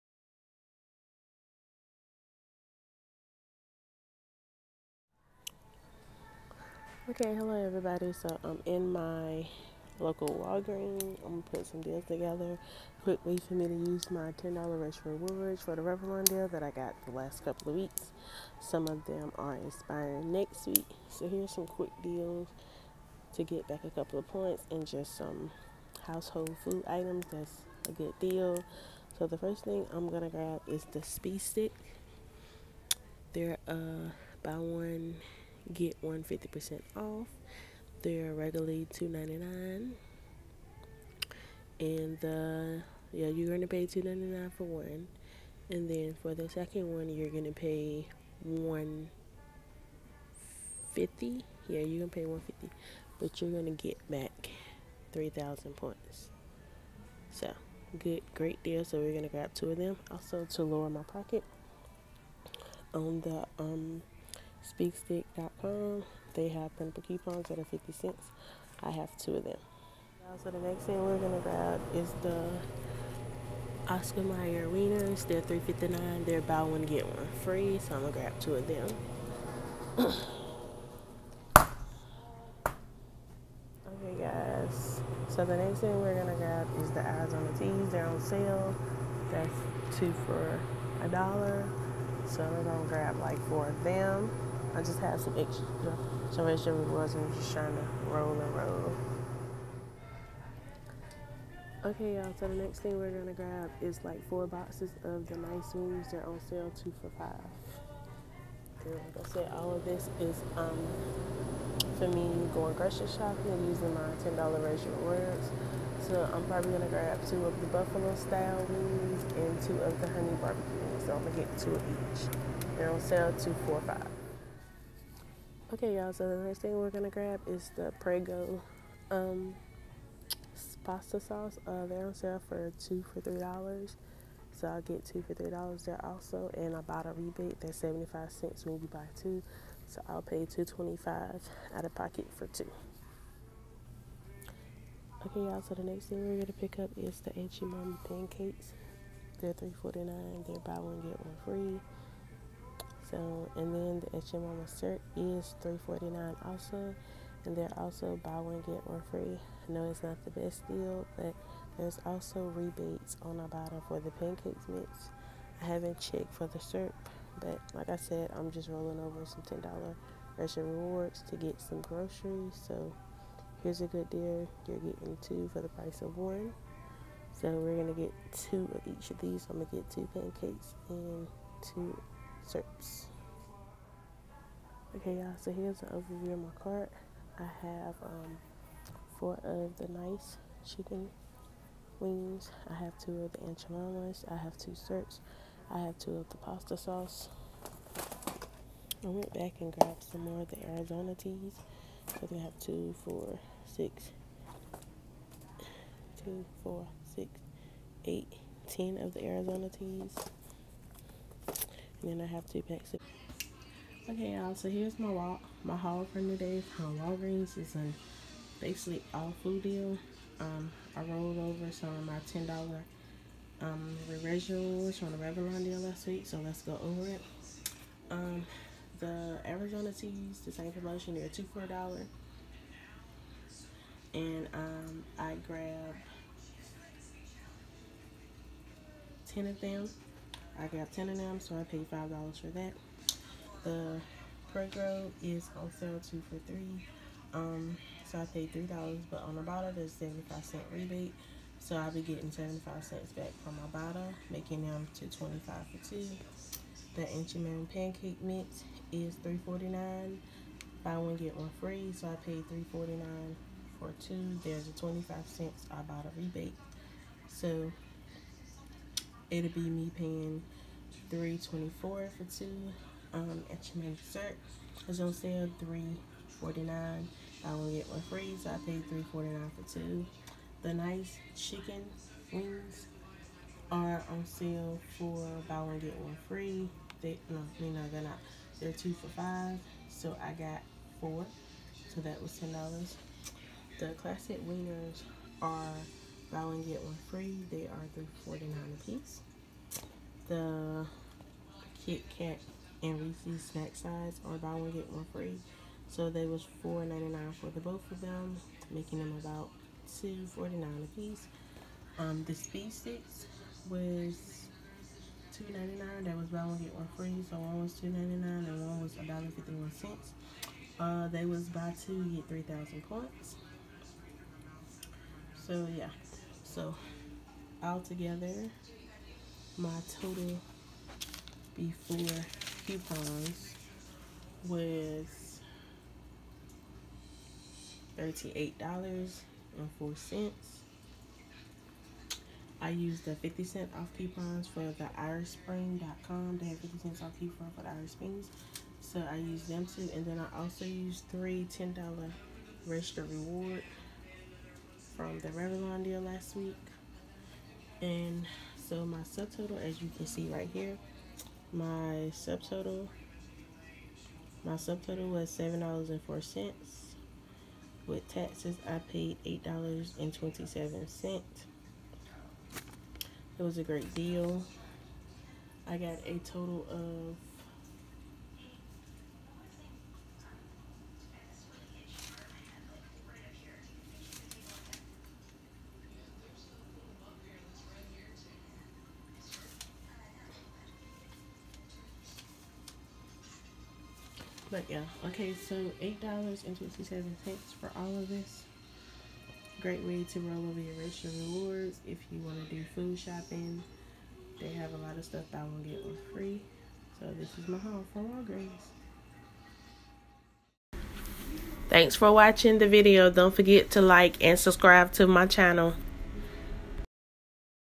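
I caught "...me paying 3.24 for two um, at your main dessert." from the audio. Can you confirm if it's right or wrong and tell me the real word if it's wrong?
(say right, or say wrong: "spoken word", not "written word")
right.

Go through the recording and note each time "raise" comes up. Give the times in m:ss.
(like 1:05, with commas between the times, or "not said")
1:54.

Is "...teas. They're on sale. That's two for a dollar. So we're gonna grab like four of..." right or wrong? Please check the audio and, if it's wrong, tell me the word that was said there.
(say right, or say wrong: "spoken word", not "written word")
right.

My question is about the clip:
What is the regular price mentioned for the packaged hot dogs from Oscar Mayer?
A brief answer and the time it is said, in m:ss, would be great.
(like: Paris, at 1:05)
$3.59, at 1:15.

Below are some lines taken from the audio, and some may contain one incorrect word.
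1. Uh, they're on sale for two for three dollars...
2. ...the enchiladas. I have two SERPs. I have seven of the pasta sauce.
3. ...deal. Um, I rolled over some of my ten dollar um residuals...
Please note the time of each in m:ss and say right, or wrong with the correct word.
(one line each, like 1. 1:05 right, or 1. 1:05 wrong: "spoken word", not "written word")
1. 2:11 right
2. 3:13 wrong: "two", not "seven"
3. 3:39 right.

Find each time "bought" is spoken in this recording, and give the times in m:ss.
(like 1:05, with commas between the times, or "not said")
2:16, 4:25.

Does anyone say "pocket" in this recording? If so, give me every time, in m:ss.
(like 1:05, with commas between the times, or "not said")
1:01, 2:21.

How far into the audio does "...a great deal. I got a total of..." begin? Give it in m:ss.
6:13.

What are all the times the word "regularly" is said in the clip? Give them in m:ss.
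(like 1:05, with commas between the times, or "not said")
0:38.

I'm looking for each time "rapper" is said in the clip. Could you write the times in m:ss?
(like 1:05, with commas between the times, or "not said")
not said.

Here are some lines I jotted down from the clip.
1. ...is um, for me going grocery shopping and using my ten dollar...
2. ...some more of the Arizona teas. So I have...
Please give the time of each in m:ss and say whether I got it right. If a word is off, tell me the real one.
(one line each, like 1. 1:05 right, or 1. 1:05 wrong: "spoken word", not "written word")
1. 1:50 right
2. 3:20 right.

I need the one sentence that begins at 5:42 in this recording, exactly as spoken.
I used the 50 cent off coupons for the IrishSpring.com.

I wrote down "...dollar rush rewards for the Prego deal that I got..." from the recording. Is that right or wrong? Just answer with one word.
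wrong.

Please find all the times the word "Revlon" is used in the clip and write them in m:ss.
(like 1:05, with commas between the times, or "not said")
0:15, 3:45, 5:55.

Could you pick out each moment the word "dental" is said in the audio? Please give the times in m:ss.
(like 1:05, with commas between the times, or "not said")
not said.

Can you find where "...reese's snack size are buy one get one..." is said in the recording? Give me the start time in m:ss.
5:03.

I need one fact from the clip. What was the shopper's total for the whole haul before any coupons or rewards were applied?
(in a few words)
$38.04.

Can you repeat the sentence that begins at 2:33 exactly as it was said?
So And then the Aunt Jemima cert is $349 also.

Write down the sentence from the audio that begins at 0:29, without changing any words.
So the first thing I'm gonna grab is the Speed Stick.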